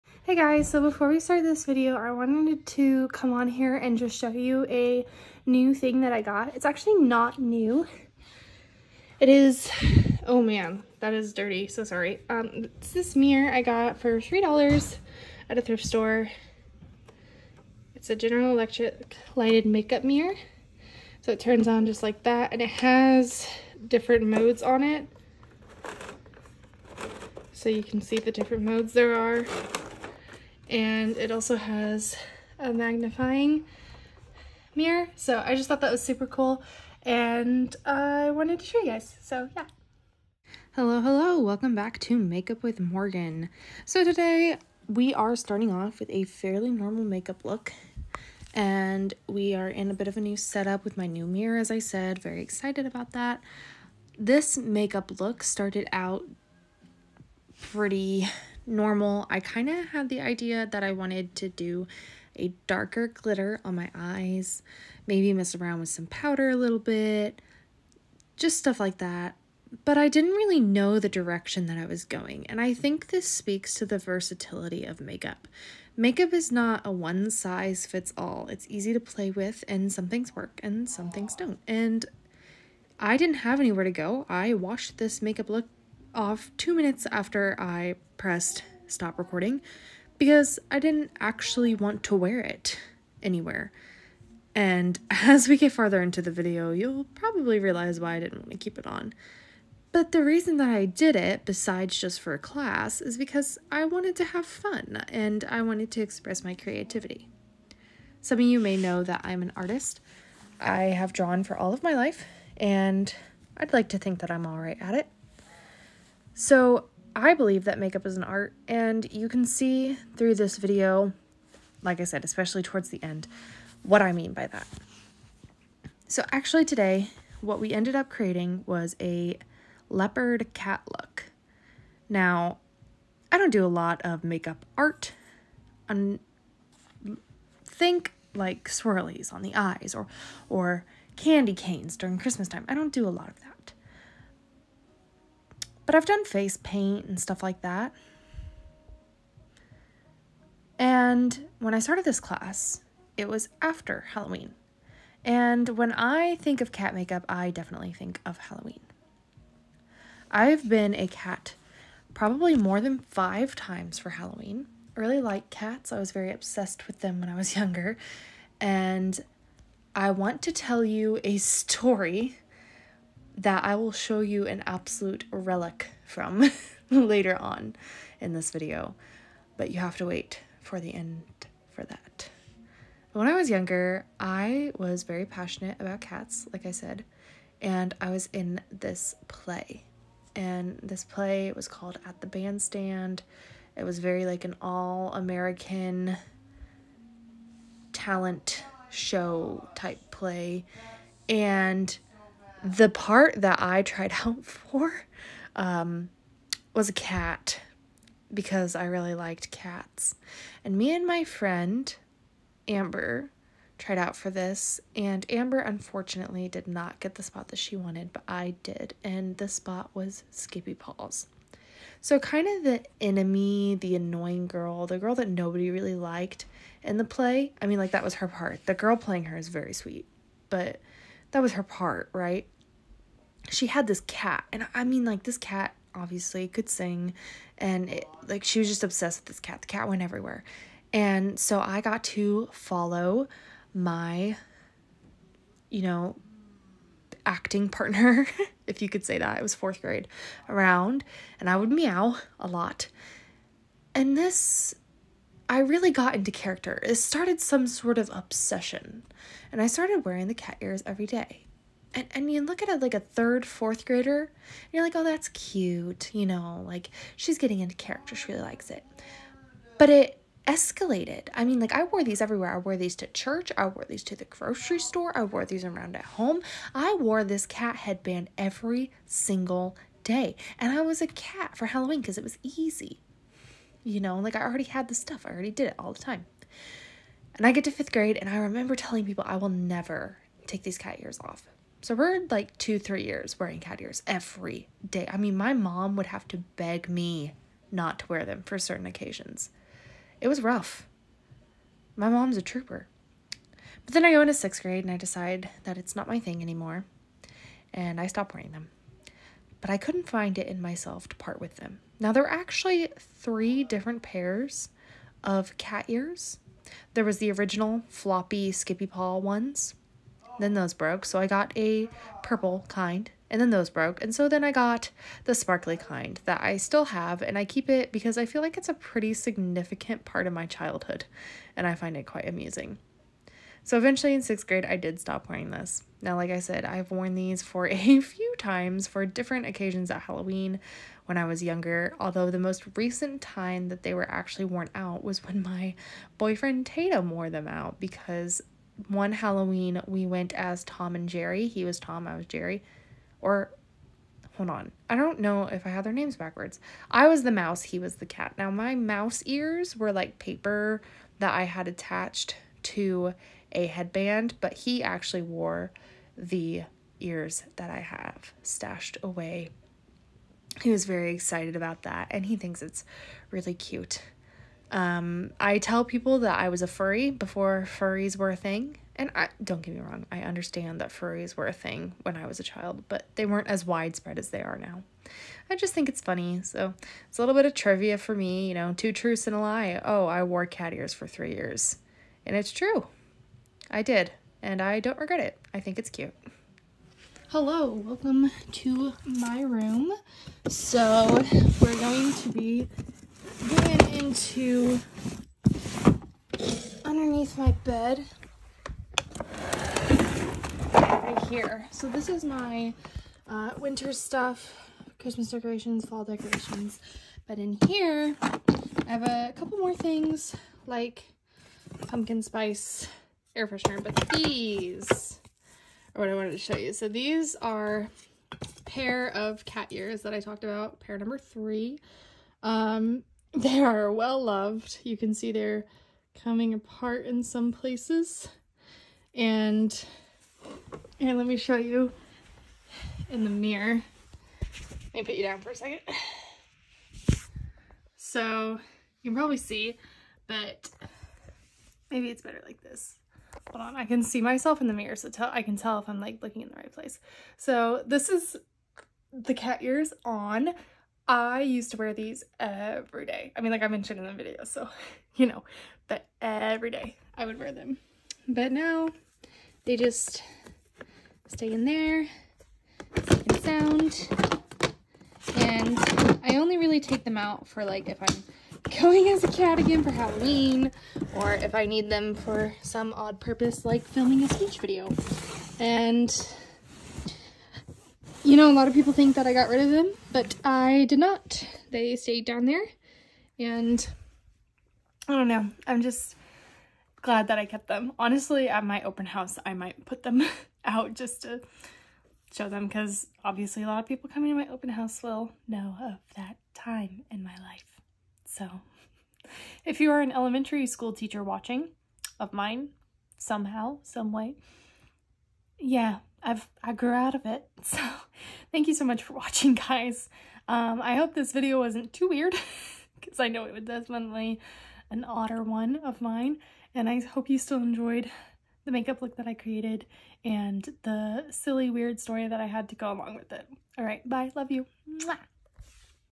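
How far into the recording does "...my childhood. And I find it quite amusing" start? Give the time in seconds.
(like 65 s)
330 s.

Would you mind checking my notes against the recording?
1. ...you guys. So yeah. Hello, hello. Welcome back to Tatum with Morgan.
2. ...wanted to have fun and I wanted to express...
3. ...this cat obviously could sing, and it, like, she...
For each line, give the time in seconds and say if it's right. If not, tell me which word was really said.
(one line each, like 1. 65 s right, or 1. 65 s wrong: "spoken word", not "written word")
1. 38 s wrong: "Makeup", not "Tatum"
2. 103 s right
3. 235 s right.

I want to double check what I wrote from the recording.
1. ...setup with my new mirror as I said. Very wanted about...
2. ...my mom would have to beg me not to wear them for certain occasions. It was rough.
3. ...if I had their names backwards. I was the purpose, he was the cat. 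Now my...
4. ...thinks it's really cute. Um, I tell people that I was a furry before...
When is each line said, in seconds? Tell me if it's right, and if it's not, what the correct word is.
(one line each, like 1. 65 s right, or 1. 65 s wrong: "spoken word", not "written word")
1. 50 s wrong: "excited", not "wanted"
2. 295 s right
3. 355 s wrong: "mouse", not "purpose"
4. 372 s right.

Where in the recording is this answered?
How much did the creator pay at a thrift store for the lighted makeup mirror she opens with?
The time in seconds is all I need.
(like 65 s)
14 s.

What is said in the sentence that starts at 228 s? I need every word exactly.
The girl playing her is very sweet, but that was her part, right?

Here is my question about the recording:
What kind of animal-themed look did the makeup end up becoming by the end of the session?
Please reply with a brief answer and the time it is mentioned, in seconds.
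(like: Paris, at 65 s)
leopard cat, at 129 s.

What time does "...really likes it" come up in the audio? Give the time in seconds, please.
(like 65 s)
268 s.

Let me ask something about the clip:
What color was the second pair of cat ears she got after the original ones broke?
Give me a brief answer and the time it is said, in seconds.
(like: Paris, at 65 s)
purple, at 322 s.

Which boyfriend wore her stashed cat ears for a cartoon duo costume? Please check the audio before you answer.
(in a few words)
Tatum.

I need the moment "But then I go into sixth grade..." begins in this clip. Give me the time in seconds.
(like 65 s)
303 s.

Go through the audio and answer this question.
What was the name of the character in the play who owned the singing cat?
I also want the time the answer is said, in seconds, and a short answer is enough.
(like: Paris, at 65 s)
Skippy Paws, at 220 s.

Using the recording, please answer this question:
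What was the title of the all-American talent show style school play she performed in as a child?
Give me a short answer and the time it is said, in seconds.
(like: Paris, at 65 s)
At the Bandstand, at 192 s.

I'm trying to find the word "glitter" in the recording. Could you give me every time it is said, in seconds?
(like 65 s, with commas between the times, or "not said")
63 s.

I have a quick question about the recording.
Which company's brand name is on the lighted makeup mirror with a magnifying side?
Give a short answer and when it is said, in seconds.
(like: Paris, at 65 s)
General Electric, at 18 s.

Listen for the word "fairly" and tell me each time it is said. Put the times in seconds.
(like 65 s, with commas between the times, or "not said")
46 s.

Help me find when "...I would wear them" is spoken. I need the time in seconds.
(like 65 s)
467 s.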